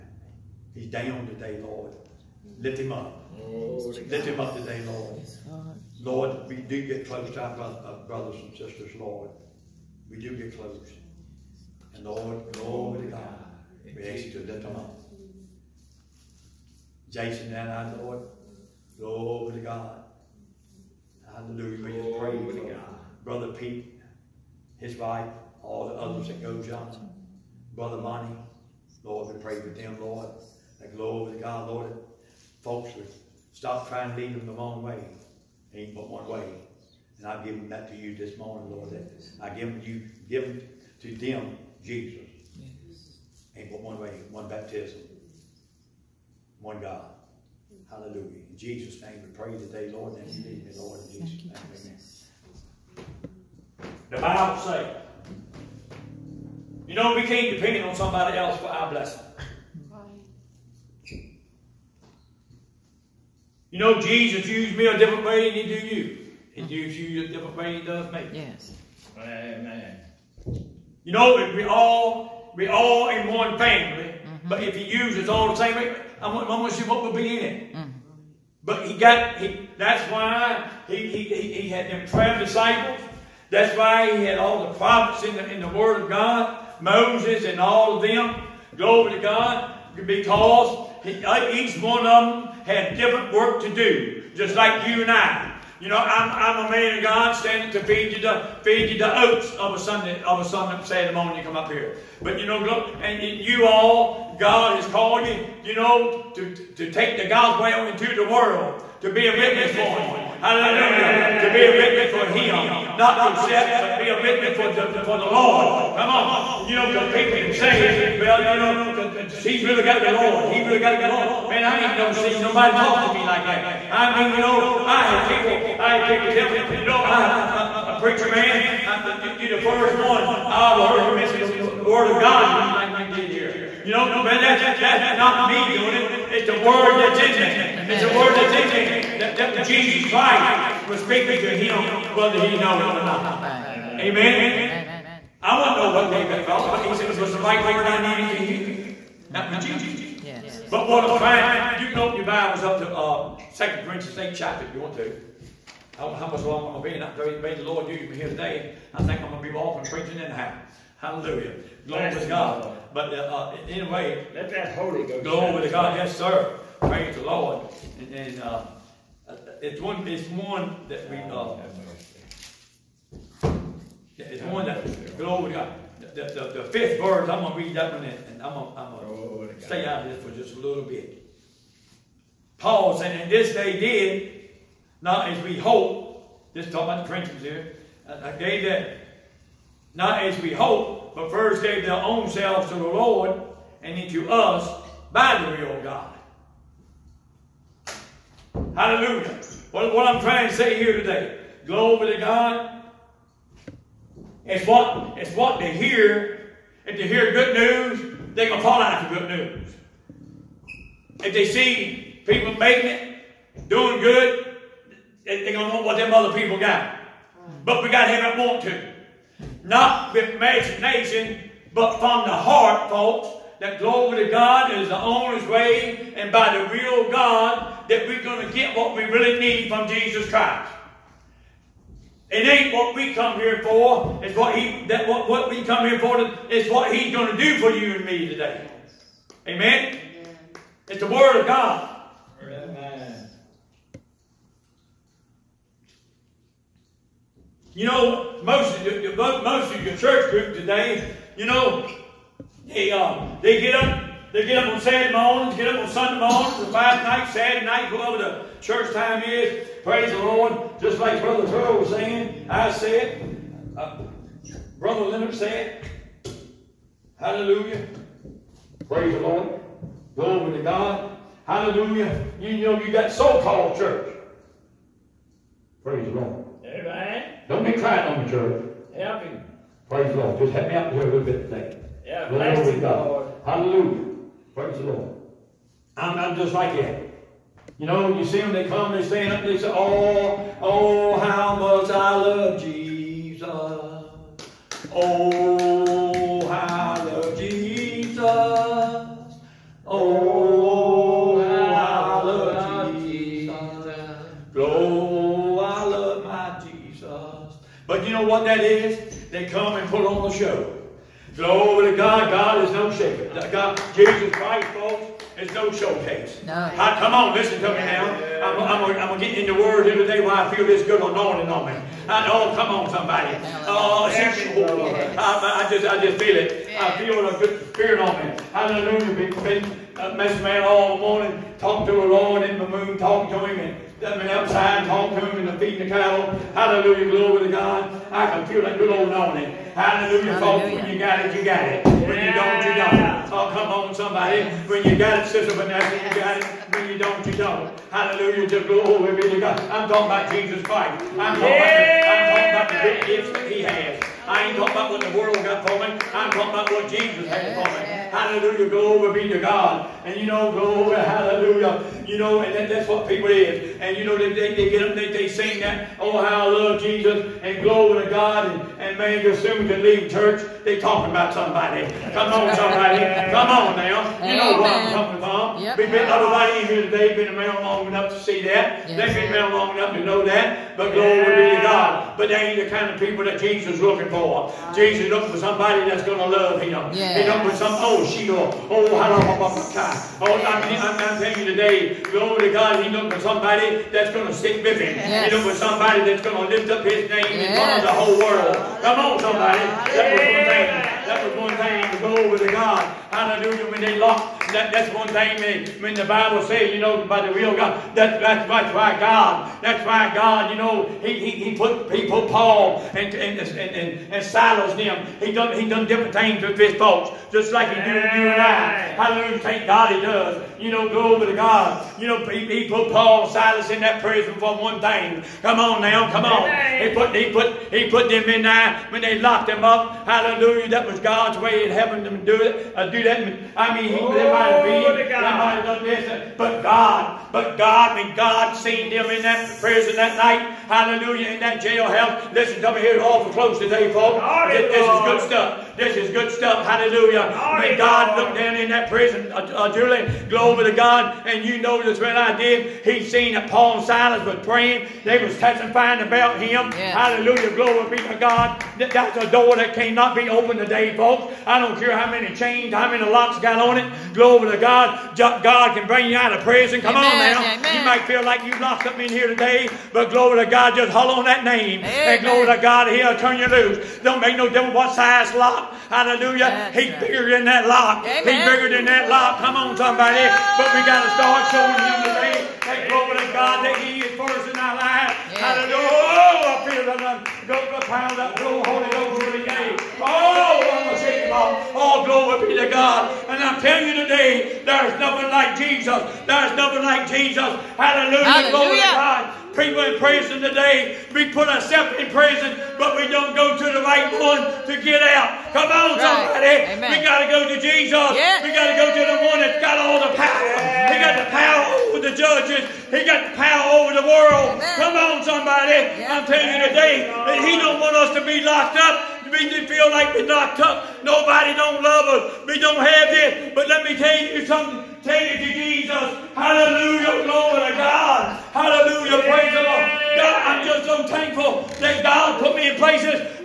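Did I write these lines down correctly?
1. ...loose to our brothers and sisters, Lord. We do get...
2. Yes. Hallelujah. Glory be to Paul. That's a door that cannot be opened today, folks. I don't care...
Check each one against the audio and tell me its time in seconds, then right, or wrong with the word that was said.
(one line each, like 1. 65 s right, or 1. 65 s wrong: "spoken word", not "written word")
1. 7 s wrong: "close", not "loose"
2. 456 s wrong: "God", not "Paul".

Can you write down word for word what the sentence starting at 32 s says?
Folks, Stop trying to lead them the wrong way.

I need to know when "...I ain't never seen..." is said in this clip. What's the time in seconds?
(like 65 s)
121 s.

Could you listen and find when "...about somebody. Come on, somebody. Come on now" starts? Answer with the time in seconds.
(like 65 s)
371 s.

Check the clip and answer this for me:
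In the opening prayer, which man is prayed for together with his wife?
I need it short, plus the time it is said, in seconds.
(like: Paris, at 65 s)
Brother Pete, at 23 s.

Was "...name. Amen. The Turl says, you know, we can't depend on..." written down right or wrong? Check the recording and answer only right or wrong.
wrong.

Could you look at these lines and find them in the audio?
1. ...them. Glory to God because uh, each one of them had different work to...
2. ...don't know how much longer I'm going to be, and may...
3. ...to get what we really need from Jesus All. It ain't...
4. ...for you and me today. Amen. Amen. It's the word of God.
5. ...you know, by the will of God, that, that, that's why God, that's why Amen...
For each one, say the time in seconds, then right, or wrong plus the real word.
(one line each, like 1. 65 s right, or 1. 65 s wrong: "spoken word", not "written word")
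1. 88 s right
2. 156 s right
3. 228 s wrong: "Christ", not "All"
4. 237 s right
5. 406 s wrong: "God", not "Amen".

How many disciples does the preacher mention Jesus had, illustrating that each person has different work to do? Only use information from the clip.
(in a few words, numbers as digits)
12.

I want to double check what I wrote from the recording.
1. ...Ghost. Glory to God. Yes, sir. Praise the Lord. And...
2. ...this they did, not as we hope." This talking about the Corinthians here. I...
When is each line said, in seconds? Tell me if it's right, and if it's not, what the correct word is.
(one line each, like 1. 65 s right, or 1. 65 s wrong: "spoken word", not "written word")
1. 165 s right
2. 183 s right.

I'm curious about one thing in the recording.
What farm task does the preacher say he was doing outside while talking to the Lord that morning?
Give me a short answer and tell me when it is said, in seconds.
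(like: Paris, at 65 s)
Feeding the cattle, at 335 s.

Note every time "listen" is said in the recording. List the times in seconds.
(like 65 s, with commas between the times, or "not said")
317 s, 442 s.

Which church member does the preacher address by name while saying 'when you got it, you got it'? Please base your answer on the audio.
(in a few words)
Sister Vanessa.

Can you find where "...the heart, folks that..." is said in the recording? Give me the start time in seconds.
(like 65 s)
222 s.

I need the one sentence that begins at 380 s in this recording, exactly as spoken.
But glory but they ain't the kind of people that Jesus is looking for.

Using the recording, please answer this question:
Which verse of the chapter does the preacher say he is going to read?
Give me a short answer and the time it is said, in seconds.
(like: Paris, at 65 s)
The fifth verse, at 175 s.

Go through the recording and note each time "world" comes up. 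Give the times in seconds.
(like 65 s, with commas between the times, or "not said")
108 s, 355 s, 398 s, 514 s.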